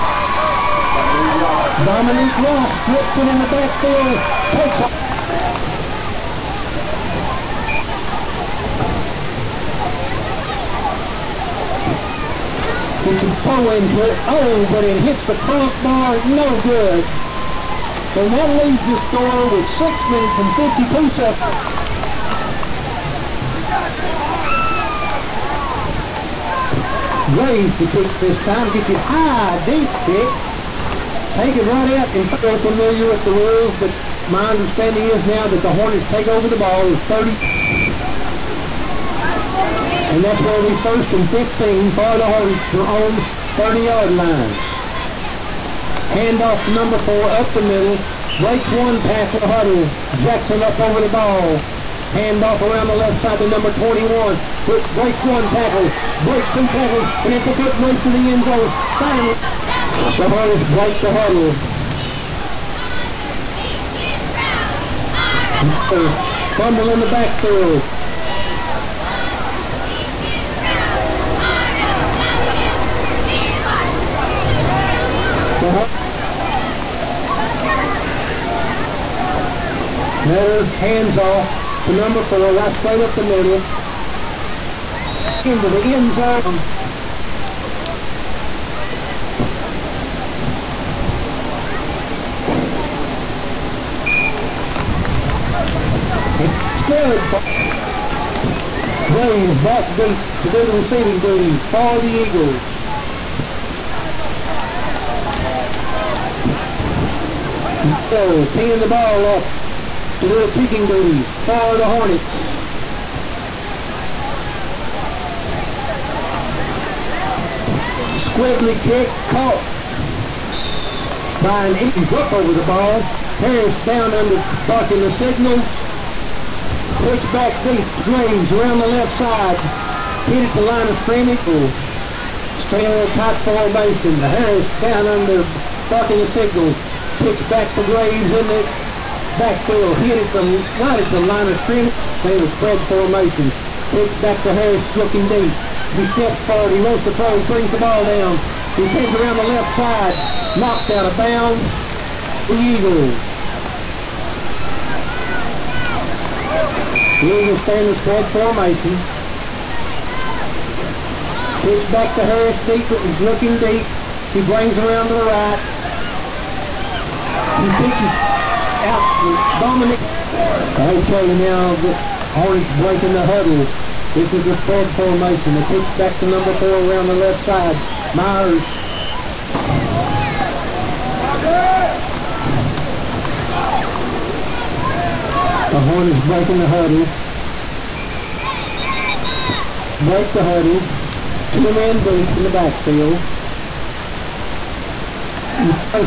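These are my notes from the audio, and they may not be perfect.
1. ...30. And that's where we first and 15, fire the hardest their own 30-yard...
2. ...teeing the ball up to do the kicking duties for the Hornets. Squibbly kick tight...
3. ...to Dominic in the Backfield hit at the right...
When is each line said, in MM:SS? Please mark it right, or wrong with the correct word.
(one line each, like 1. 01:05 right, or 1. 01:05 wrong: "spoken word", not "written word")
1. 00:37 right
2. 01:48 wrong: "caught", not "tight"
3. 02:17 wrong: "Graves", not "Dominic".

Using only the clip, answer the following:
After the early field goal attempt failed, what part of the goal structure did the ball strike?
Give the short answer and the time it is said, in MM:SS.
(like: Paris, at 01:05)
Crossbar, at 00:15.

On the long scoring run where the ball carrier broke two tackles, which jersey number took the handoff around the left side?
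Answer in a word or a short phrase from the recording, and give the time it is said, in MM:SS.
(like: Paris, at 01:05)
21, at 00:53.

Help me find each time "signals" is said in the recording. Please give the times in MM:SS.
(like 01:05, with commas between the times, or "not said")
02:05, 02:16.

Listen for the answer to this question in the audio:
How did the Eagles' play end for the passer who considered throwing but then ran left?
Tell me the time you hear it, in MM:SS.
02:30.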